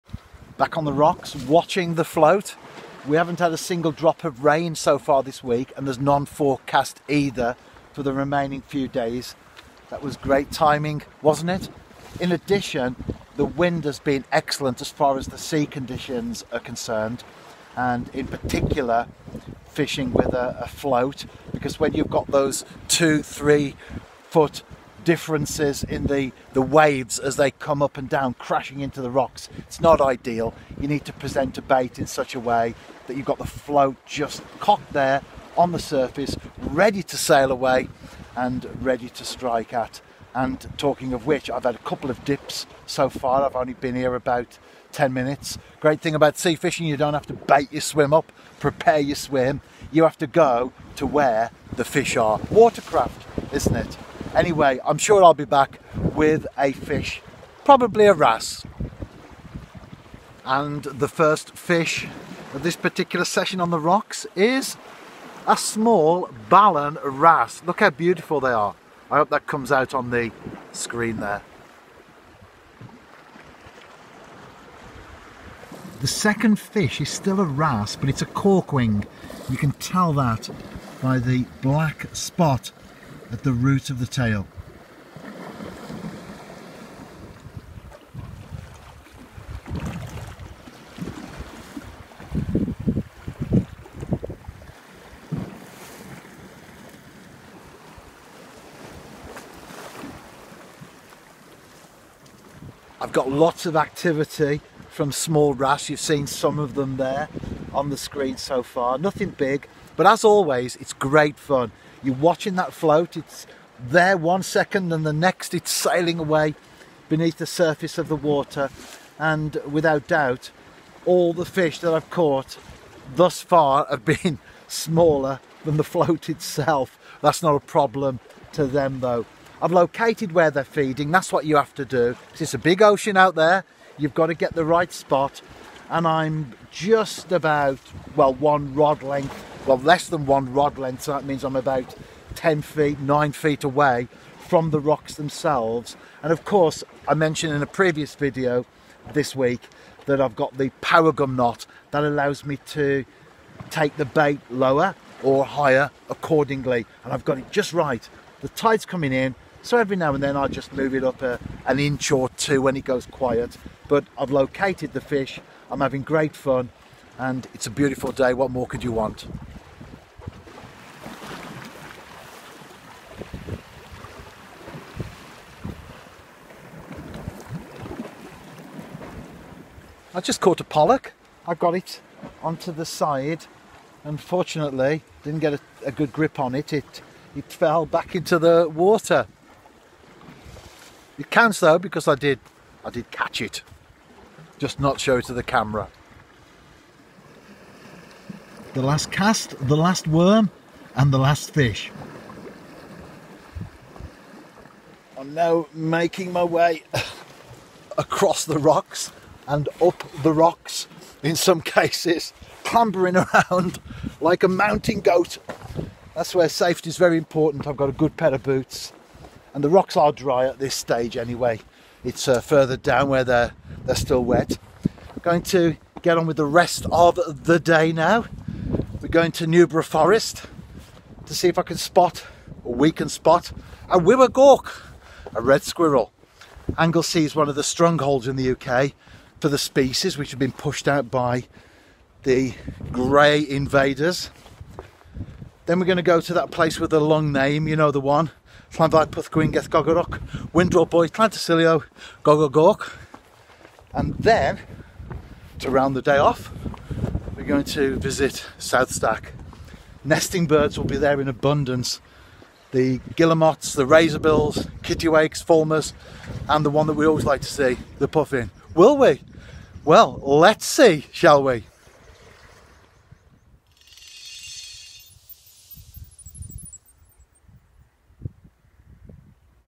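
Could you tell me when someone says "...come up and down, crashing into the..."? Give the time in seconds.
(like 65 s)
27 s.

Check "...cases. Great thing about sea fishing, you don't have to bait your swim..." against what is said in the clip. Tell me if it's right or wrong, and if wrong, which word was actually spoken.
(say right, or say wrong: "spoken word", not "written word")
wrong: "minutes", not "cases".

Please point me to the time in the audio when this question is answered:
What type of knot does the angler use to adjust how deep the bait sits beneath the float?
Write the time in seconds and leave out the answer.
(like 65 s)
150 s.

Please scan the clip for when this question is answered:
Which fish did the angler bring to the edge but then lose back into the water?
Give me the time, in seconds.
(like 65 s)
180 s.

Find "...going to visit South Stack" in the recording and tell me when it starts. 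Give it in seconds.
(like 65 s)
257 s.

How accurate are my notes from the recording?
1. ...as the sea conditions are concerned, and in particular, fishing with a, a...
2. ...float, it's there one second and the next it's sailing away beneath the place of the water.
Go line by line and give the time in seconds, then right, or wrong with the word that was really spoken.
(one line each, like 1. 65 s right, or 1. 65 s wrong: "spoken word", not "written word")
1. 15 s right
2. 112 s wrong: "surface", not "place".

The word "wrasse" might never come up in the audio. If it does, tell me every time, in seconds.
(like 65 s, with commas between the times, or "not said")
58 s, 67 s, 77 s.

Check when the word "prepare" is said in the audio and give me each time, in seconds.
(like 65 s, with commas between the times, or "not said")
48 s.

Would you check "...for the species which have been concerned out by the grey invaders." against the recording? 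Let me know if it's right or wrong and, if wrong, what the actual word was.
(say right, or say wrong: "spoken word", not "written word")
wrong: "pushed", not "concerned".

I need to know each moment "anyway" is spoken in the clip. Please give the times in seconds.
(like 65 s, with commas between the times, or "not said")
54 s, 221 s.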